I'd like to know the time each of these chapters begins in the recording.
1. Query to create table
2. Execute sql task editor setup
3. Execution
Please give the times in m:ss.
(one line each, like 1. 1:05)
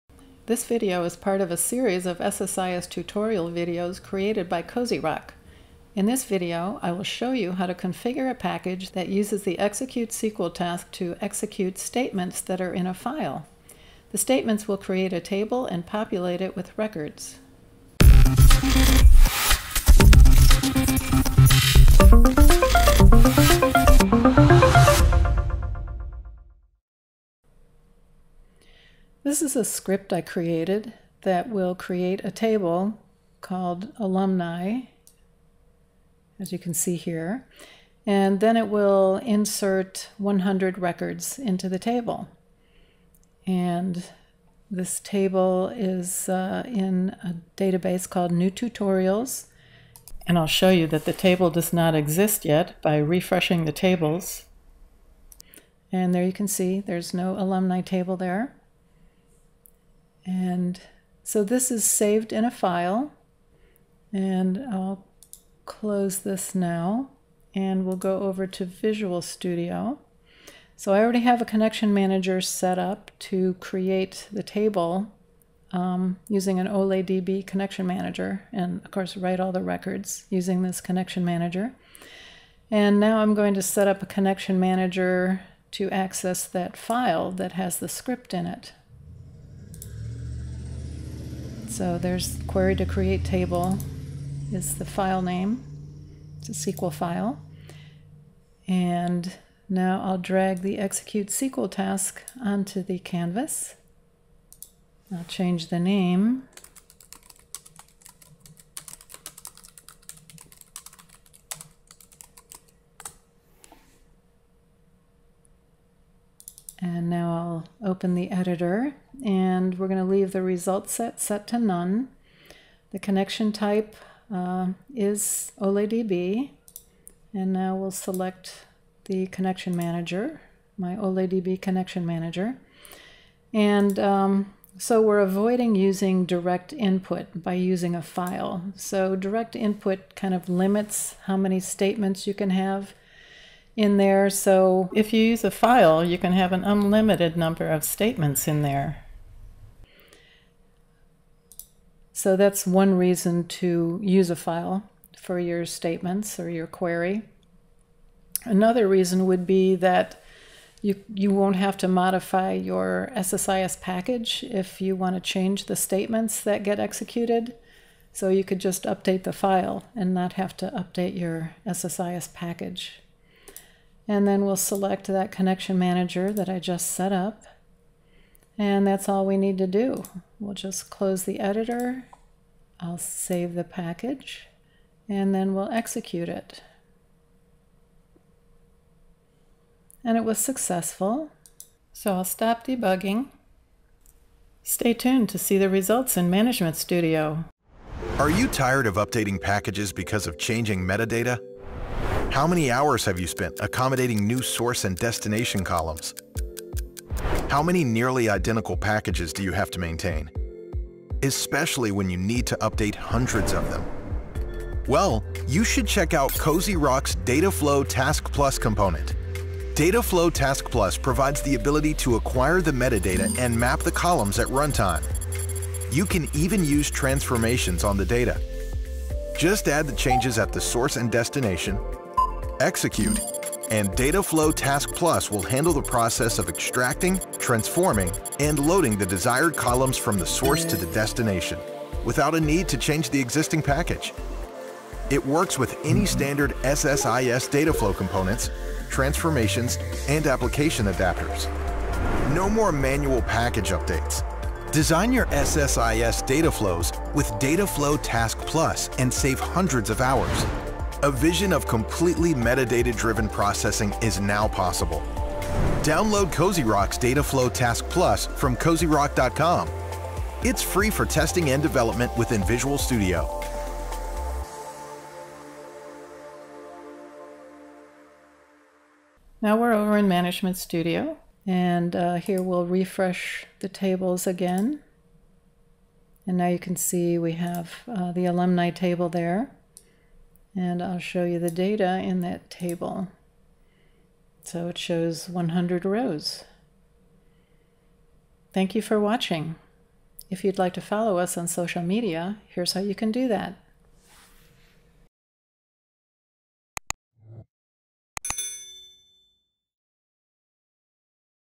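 1. 1:34
2. 2:15
3. 3:11.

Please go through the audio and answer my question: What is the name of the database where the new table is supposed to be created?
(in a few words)
New Tutorials.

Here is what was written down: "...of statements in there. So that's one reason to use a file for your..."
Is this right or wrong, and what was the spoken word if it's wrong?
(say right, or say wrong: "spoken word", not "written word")
right.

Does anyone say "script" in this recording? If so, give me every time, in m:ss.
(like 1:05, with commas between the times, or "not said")
0:29, 1:27.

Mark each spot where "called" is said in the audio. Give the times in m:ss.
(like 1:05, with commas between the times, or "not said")
0:33, 0:48.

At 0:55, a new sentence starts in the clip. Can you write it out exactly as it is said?
And there you can see there's no alumni table there.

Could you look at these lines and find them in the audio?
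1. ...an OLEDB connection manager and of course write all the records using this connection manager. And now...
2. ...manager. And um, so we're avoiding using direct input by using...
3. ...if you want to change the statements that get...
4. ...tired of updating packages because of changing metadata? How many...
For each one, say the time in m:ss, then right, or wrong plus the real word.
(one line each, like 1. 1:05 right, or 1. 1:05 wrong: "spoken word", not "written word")
1. 1:16 right
2. 2:12 right
3. 2:44 right
4. 3:18 right.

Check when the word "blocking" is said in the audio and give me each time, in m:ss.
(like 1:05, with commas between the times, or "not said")
not said.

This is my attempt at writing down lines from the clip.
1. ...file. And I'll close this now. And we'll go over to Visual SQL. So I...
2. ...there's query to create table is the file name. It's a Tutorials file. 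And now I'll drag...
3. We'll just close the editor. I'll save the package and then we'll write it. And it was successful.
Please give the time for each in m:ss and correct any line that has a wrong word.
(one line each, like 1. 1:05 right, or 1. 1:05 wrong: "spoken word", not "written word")
1. 1:02 wrong: "Studio", not "SQL"
2. 1:31 wrong: "SQL", not "Tutorials"
3. 3:00 wrong: "execute", not "write".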